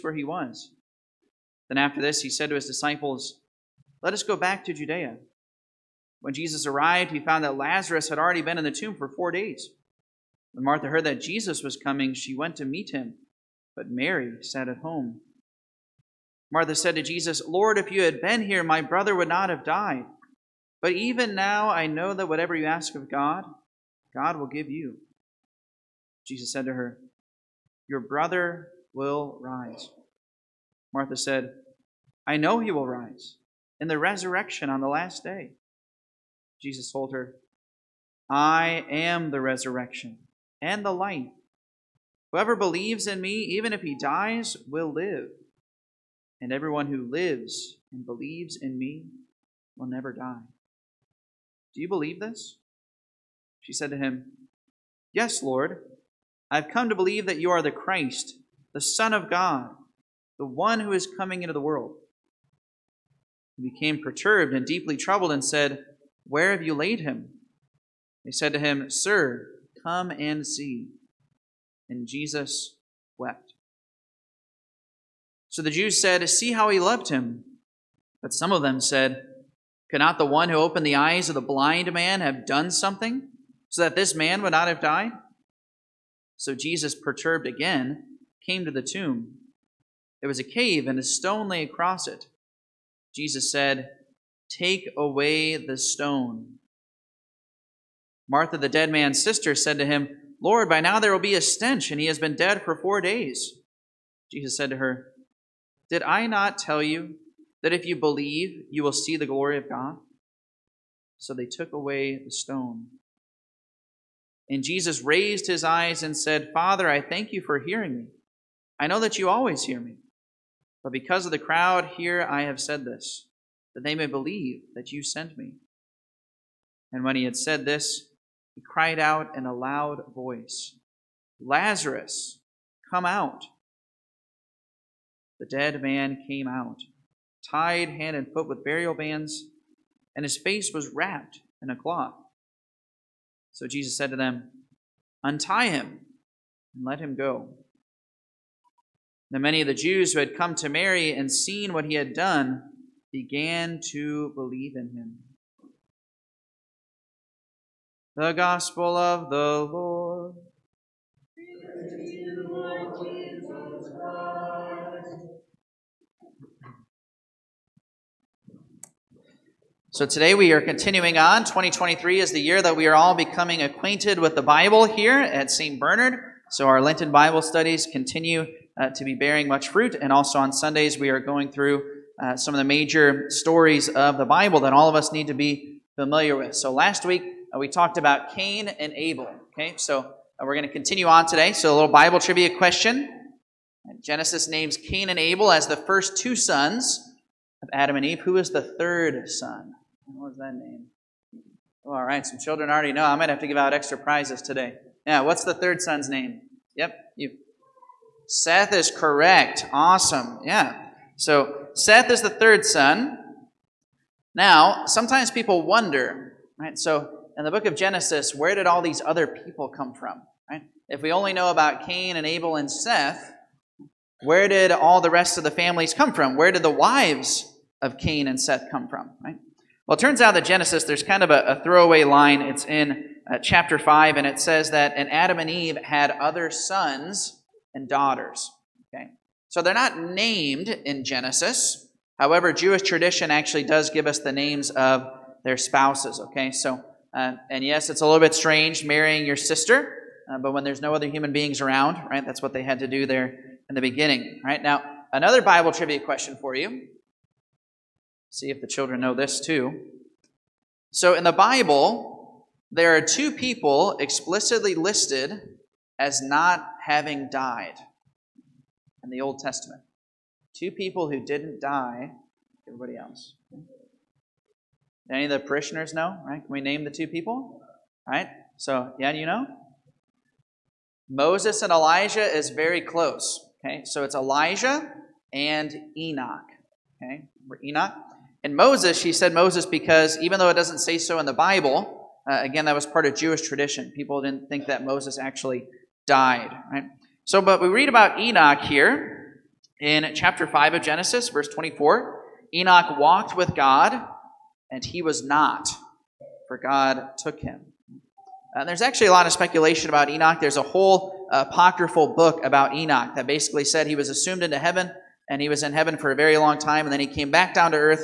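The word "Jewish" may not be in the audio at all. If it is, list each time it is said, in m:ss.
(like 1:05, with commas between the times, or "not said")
4:02, 4:53.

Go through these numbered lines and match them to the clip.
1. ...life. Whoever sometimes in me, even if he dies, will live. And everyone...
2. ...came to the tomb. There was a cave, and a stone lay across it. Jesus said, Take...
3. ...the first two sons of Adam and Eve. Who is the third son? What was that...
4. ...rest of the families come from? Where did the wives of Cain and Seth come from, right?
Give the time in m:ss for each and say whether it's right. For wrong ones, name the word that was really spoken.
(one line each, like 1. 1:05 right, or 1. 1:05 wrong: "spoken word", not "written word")
1. 0:40 wrong: "believes", not "sometimes"
2. 1:28 right
3. 3:15 right
4. 3:45 right.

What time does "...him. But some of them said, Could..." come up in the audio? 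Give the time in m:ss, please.
1:17.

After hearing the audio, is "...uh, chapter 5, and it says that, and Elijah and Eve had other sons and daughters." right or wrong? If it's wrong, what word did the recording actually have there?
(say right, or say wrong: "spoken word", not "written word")
wrong: "Adam", not "Elijah".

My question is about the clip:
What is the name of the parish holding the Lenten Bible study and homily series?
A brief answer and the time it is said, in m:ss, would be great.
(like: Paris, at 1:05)
St. Bernard, at 2:55.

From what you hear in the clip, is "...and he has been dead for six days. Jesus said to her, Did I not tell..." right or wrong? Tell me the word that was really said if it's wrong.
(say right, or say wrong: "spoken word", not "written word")
wrong: "four", not "six".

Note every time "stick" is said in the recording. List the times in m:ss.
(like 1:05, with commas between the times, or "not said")
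not said.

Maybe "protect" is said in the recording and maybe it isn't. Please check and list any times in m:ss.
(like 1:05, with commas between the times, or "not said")
not said.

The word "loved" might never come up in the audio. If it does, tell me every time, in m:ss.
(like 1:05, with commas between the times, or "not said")
1:16.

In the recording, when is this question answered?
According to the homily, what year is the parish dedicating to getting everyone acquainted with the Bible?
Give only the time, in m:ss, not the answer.
2:51.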